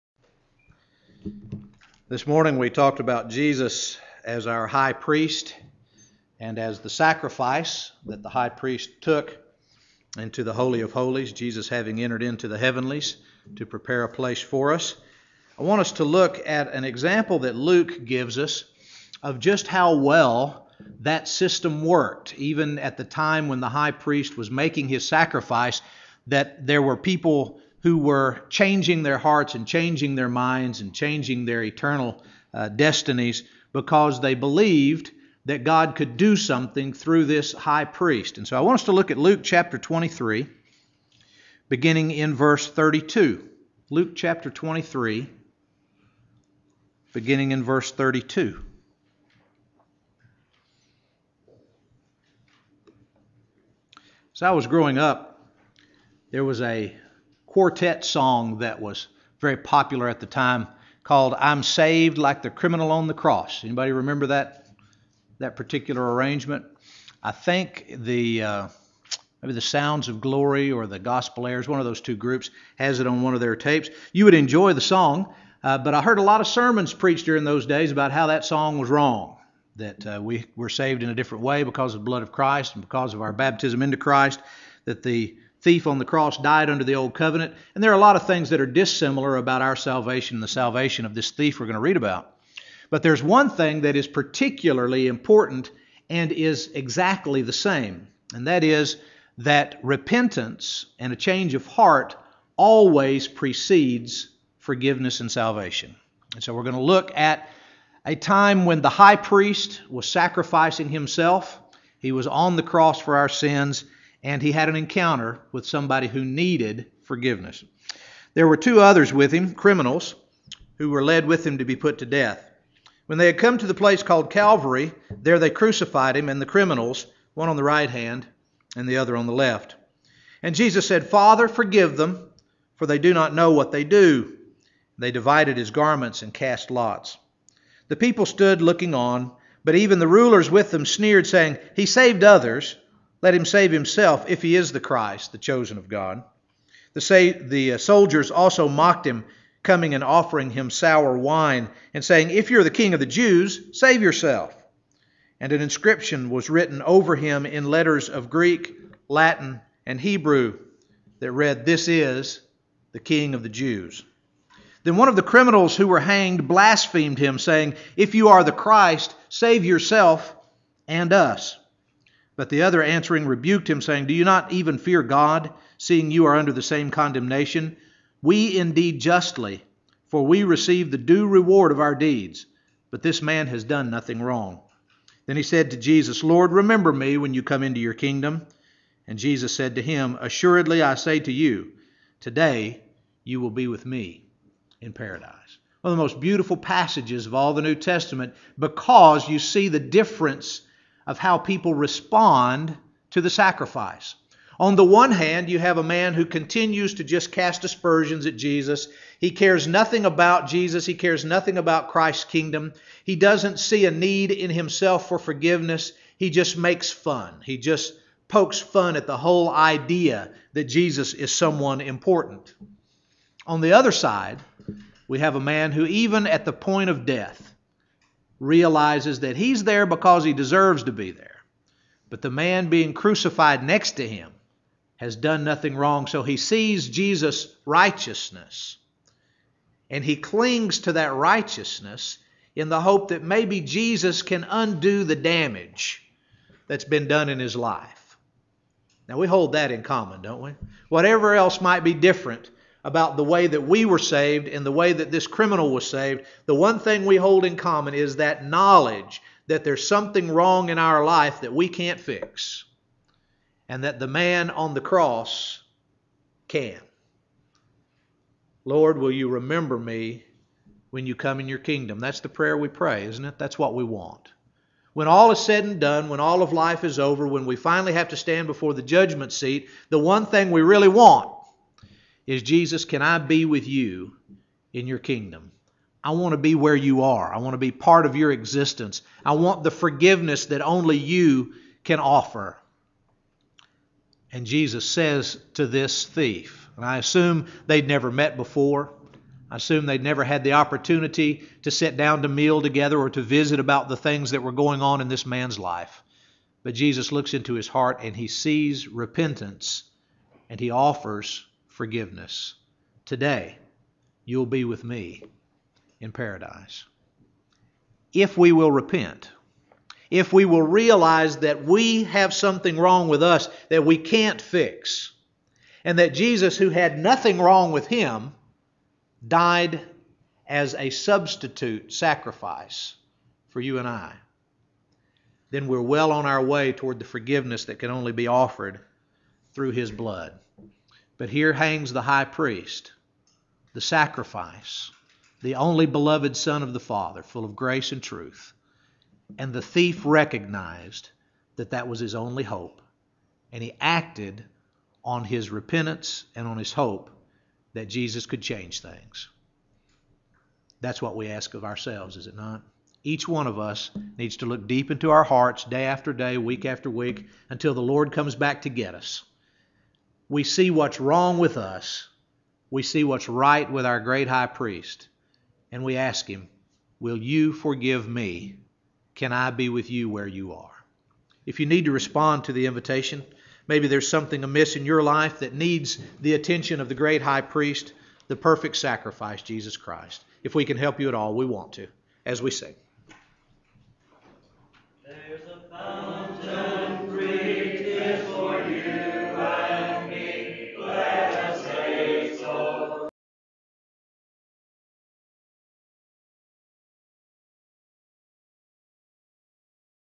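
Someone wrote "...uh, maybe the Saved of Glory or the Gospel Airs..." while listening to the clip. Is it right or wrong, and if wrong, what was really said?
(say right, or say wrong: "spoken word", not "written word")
wrong: "Sounds", not "Saved".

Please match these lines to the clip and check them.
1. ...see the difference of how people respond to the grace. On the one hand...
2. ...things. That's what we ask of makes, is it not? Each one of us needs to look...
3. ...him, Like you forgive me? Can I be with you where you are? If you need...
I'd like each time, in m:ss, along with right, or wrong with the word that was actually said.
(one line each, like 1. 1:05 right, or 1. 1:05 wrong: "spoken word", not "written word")
1. 3:19 wrong: "sacrifice", not "grace"
2. 5:58 wrong: "ourselves", not "makes"
3. 6:16 wrong: "Will", not "Like".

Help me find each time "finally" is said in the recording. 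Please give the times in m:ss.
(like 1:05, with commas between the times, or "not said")
4:37.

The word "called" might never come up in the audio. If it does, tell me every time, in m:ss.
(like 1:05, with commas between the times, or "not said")
1:01, 2:04.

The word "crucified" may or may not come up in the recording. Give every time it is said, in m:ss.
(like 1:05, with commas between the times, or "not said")
2:05, 3:52.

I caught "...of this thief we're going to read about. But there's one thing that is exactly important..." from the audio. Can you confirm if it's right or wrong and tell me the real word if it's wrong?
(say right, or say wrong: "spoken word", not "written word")
wrong: "particularly", not "exactly".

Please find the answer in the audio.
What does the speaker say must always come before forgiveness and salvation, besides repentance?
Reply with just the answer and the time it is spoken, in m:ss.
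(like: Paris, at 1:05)
A change of heart, at 1:41.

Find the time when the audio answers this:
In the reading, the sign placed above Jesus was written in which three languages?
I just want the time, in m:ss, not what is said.
2:38.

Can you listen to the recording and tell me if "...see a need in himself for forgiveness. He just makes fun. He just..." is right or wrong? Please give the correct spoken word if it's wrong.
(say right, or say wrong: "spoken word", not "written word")
right.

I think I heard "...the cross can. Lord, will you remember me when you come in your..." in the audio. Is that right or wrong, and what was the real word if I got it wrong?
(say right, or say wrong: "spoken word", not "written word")
right.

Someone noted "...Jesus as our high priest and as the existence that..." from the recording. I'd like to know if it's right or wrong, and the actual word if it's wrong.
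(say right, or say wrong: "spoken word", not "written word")
wrong: "sacrifice", not "existence".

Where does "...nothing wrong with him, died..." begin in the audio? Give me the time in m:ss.
5:26.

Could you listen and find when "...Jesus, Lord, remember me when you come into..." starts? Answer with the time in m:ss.
3:05.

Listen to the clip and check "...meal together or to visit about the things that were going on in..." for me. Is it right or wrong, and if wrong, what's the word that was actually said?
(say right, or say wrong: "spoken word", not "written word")
right.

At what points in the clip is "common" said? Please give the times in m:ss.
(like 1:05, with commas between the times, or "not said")
4:09, 4:17.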